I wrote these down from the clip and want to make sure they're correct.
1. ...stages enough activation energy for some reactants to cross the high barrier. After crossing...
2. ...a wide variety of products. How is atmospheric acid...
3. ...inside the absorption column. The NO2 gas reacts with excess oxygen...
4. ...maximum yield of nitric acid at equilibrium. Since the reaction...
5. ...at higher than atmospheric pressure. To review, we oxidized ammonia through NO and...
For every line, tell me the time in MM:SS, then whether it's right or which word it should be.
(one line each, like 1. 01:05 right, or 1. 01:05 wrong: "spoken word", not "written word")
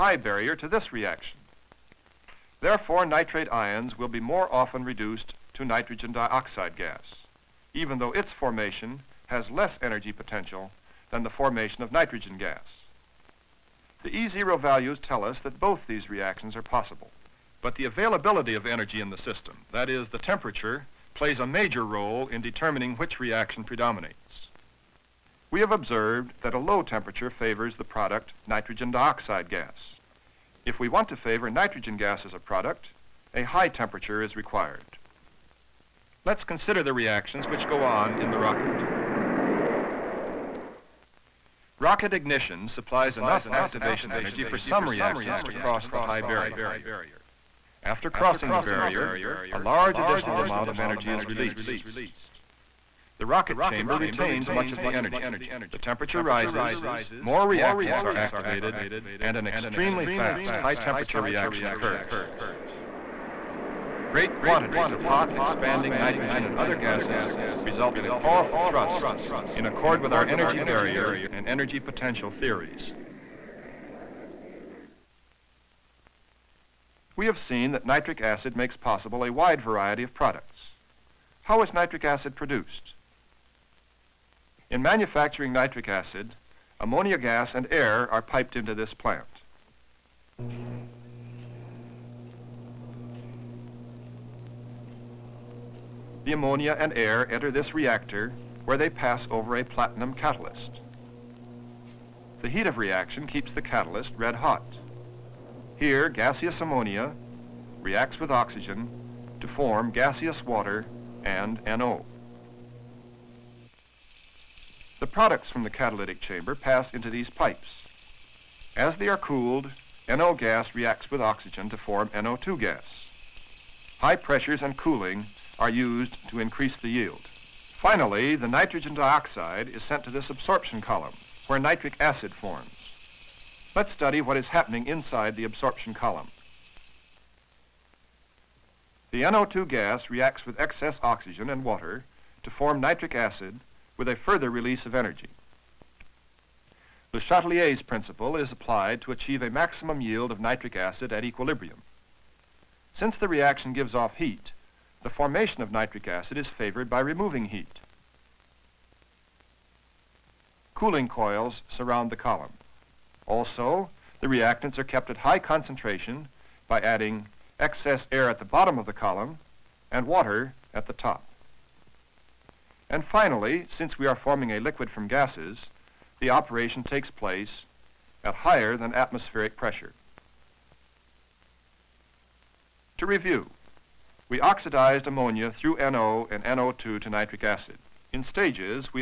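1. 00:42 wrong: "supplies", not "stages"
2. 01:19 wrong: "nitric", not "atmospheric"
3. 02:14 right
4. 02:29 right
5. 02:58 right.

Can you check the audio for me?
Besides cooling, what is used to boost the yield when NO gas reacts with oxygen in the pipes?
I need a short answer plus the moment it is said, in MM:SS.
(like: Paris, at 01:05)
High pressures, at 02:03.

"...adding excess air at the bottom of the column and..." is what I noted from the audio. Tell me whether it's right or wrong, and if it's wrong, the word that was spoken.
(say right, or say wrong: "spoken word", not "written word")
right.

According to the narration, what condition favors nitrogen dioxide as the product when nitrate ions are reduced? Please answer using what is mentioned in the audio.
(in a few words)
low temperature.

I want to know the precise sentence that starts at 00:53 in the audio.
The rocket chamber retains much of the energy.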